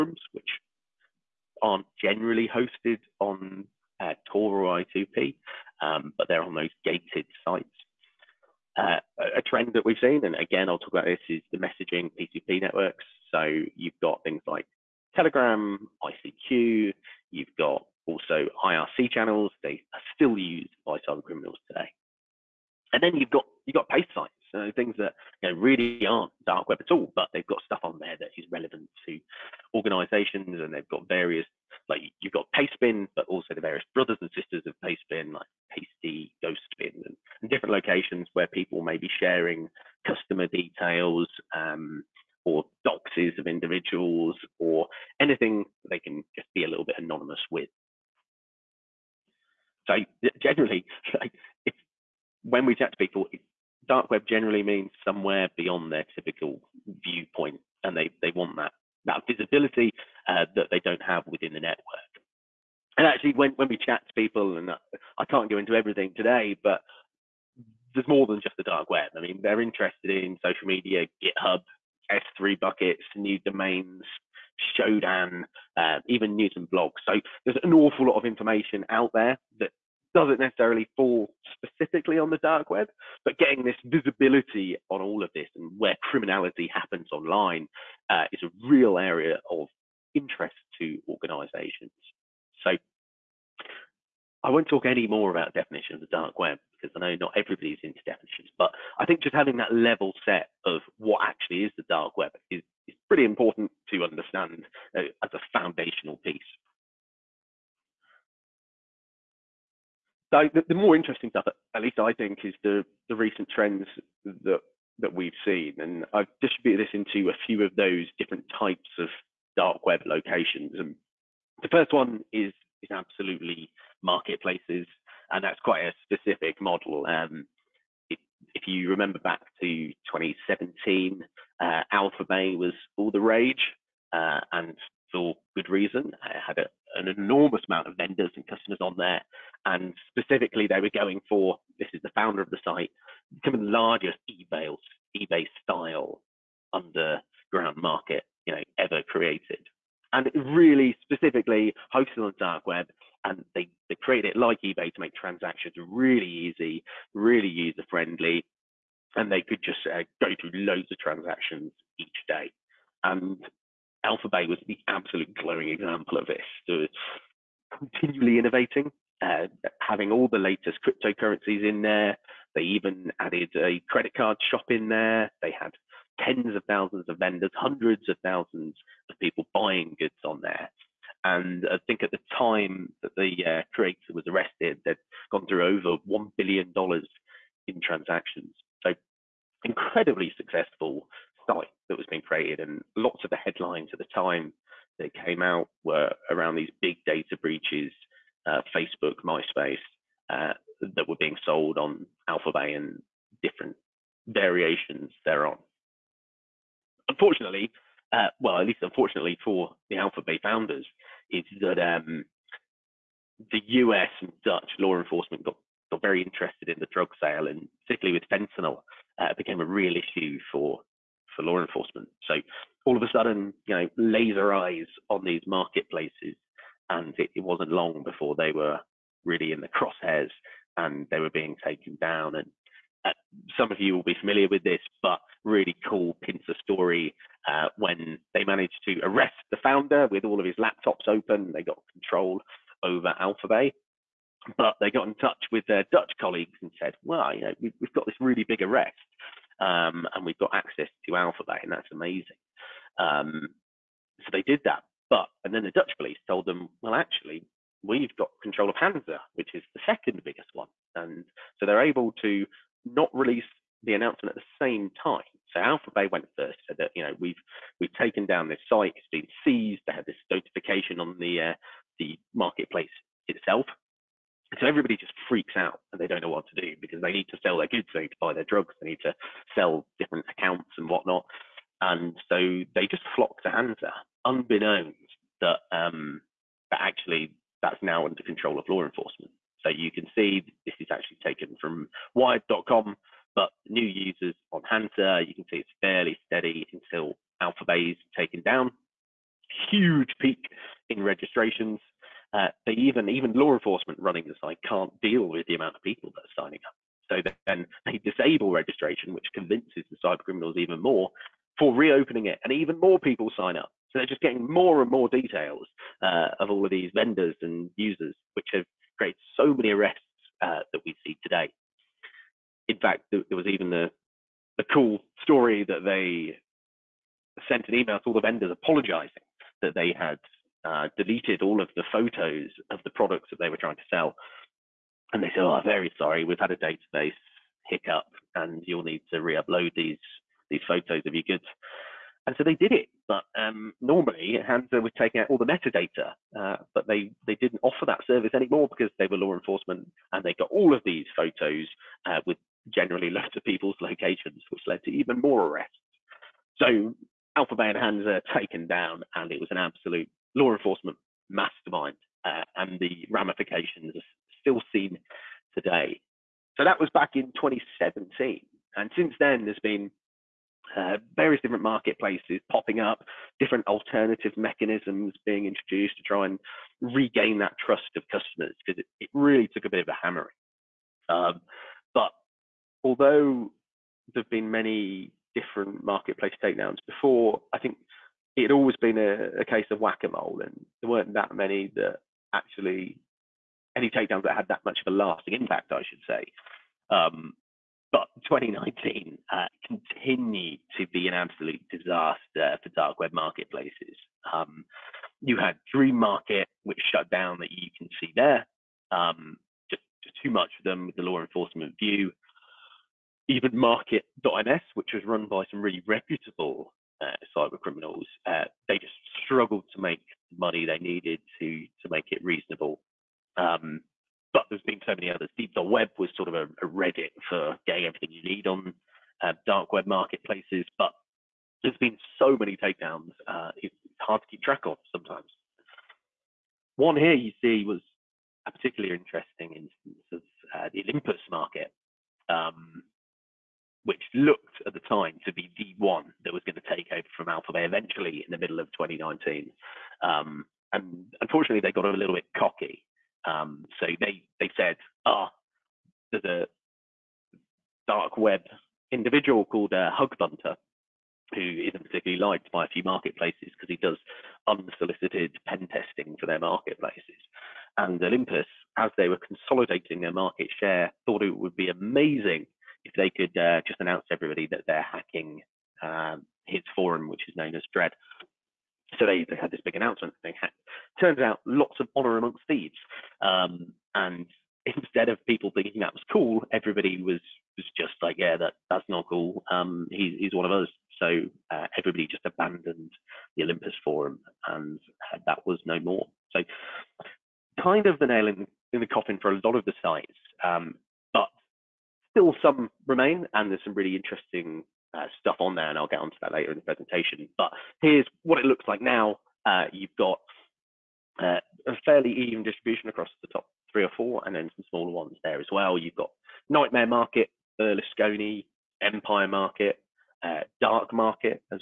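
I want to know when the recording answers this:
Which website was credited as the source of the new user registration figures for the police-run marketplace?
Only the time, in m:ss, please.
4:52.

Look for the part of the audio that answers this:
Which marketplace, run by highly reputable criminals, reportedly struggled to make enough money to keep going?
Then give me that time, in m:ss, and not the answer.
6:53.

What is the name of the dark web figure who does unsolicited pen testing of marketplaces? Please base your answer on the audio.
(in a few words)
Hugbunter.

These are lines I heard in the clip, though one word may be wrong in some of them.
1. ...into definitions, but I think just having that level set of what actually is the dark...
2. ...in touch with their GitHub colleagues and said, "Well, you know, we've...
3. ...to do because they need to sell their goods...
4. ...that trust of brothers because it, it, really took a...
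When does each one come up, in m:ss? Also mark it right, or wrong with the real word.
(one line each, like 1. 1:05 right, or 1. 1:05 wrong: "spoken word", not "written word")
1. 1:37 right
2. 4:05 wrong: "Dutch", not "GitHub"
3. 4:36 right
4. 6:17 wrong: "customers", not "brothers".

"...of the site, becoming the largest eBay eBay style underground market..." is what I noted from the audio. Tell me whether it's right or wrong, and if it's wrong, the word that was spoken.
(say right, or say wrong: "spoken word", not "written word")
right.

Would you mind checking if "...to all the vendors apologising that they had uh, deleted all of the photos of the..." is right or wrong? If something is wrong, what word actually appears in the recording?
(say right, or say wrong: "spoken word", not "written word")
right.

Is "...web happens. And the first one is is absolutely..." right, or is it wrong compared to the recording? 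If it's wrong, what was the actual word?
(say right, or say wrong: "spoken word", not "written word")
wrong: "locations", not "happens".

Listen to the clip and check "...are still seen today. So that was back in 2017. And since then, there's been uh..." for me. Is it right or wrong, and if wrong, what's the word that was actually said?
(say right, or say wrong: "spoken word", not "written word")
right.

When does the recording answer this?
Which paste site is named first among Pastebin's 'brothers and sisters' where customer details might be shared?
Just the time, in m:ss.
0:35.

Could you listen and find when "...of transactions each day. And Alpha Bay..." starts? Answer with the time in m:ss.
2:40.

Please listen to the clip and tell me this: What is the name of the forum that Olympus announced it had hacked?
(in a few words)
Dread.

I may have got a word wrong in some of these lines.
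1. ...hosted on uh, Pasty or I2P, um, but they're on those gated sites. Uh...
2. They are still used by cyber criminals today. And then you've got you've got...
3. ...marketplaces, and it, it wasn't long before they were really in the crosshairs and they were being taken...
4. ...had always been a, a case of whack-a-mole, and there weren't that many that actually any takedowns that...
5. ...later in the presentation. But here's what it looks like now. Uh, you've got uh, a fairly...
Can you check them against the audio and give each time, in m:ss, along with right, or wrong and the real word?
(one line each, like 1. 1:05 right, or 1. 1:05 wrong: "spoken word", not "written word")
1. 0:02 wrong: "Tor", not "Pasty"
2. 0:19 right
3. 3:45 right
4. 6:28 right
5. 8:26 right.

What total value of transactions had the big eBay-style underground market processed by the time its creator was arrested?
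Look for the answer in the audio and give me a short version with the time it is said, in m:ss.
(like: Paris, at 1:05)
Over $1 billion, at 3:05.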